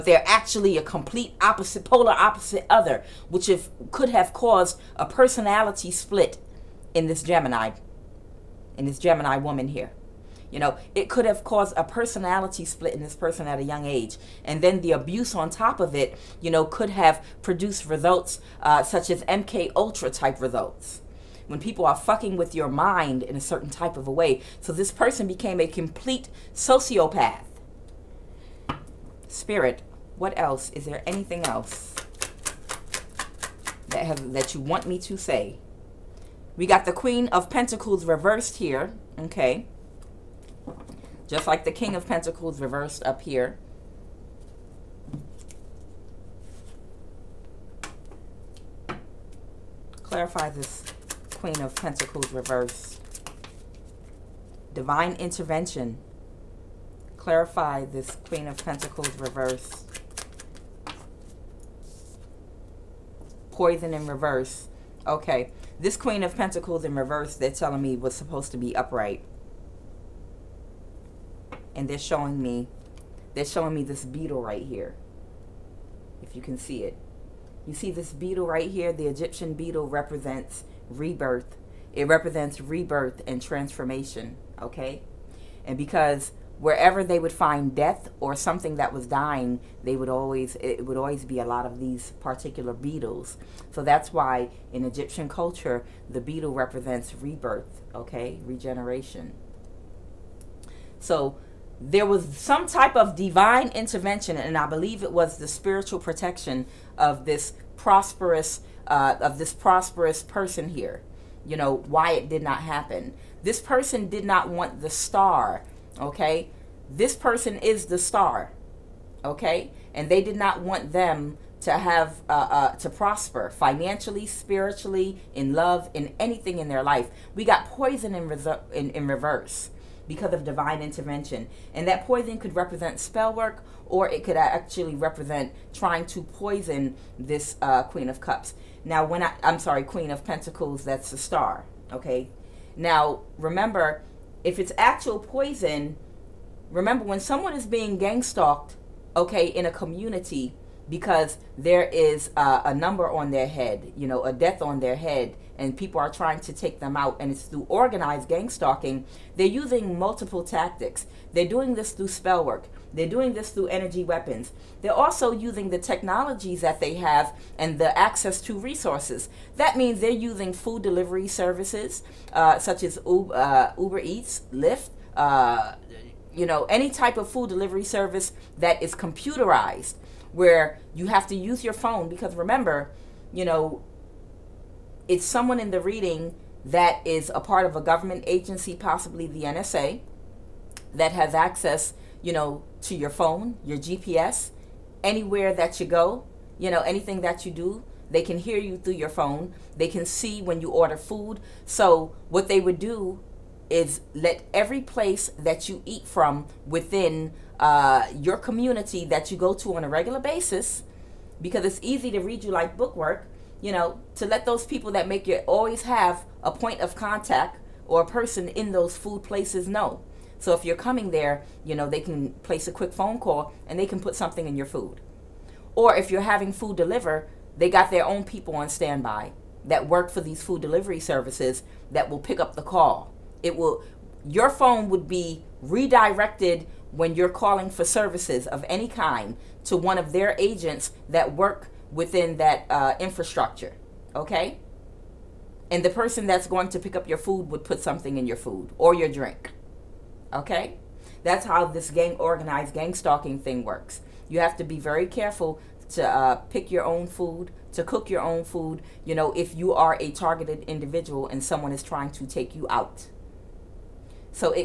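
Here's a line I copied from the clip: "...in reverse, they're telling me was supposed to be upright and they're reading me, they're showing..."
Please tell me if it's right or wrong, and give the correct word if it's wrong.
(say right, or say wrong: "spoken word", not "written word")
wrong: "showing", not "reading".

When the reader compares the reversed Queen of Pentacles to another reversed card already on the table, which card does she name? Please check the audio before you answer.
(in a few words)
King of Pentacles.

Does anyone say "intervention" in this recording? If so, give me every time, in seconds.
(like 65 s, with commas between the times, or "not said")
55 s, 103 s, 130 s.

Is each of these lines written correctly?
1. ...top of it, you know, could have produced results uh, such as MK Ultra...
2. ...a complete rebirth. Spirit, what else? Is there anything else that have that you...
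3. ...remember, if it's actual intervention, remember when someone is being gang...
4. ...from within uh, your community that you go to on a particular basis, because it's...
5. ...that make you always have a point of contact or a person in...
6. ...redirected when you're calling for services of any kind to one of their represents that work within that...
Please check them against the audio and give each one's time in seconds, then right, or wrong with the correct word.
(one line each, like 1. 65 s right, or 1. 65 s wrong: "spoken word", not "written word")
1. 15 s right
2. 25 s wrong: "sociopath", not "rebirth"
3. 143 s wrong: "poison", not "intervention"
4. 206 s wrong: "regular", not "particular"
5. 214 s right
6. 235 s wrong: "agents", not "represents".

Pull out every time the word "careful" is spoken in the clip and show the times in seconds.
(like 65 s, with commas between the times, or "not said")
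255 s.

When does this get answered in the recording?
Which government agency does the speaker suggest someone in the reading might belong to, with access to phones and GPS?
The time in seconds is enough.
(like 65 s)
189 s.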